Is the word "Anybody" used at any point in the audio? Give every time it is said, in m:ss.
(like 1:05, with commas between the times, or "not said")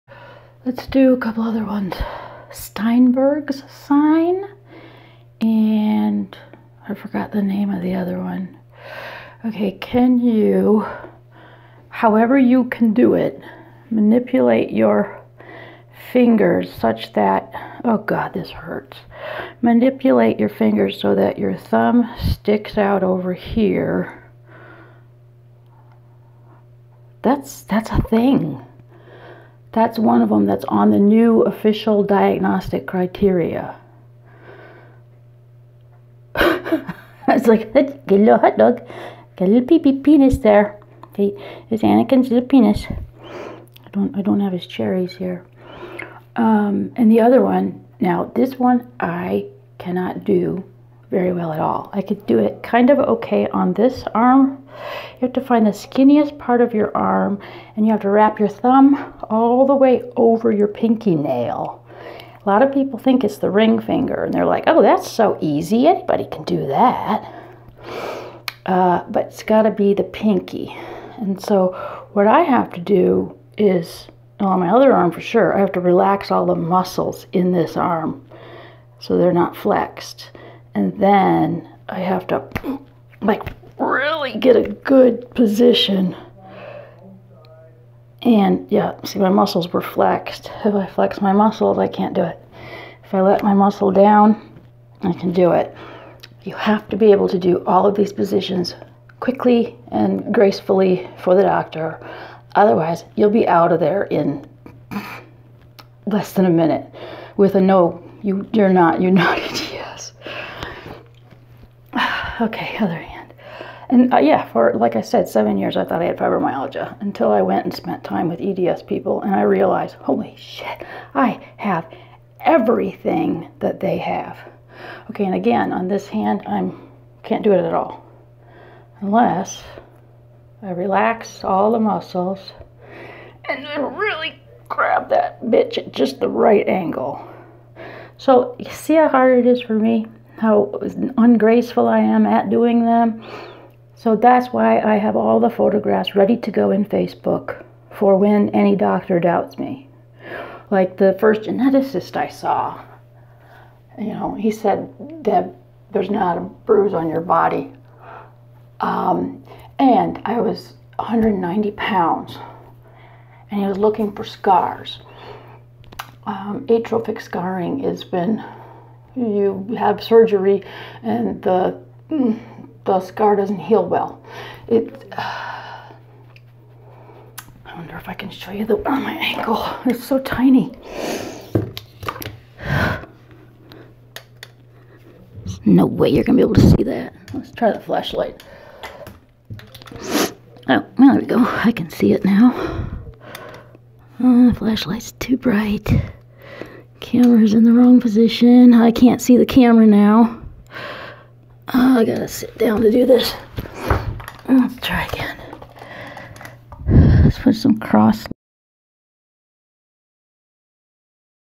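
1:05.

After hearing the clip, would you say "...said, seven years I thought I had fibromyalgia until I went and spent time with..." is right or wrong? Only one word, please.
right.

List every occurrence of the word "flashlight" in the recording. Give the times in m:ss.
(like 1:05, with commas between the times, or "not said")
3:07, 3:14.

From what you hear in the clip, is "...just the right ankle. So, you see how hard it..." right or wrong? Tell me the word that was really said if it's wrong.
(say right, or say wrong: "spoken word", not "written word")
wrong: "angle", not "ankle".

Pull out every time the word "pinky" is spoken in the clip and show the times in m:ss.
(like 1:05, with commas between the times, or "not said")
1:00, 1:10.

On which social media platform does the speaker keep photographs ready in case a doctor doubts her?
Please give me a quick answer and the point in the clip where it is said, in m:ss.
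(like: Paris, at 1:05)
Facebook, at 2:26.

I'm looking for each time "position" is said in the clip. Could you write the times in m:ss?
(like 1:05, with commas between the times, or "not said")
1:25, 1:38, 3:18.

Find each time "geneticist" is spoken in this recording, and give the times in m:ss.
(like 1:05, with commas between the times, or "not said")
2:31.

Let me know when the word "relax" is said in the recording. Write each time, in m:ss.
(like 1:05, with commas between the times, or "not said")
1:15, 2:10.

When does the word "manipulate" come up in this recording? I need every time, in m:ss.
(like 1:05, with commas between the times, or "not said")
0:13, 0:19.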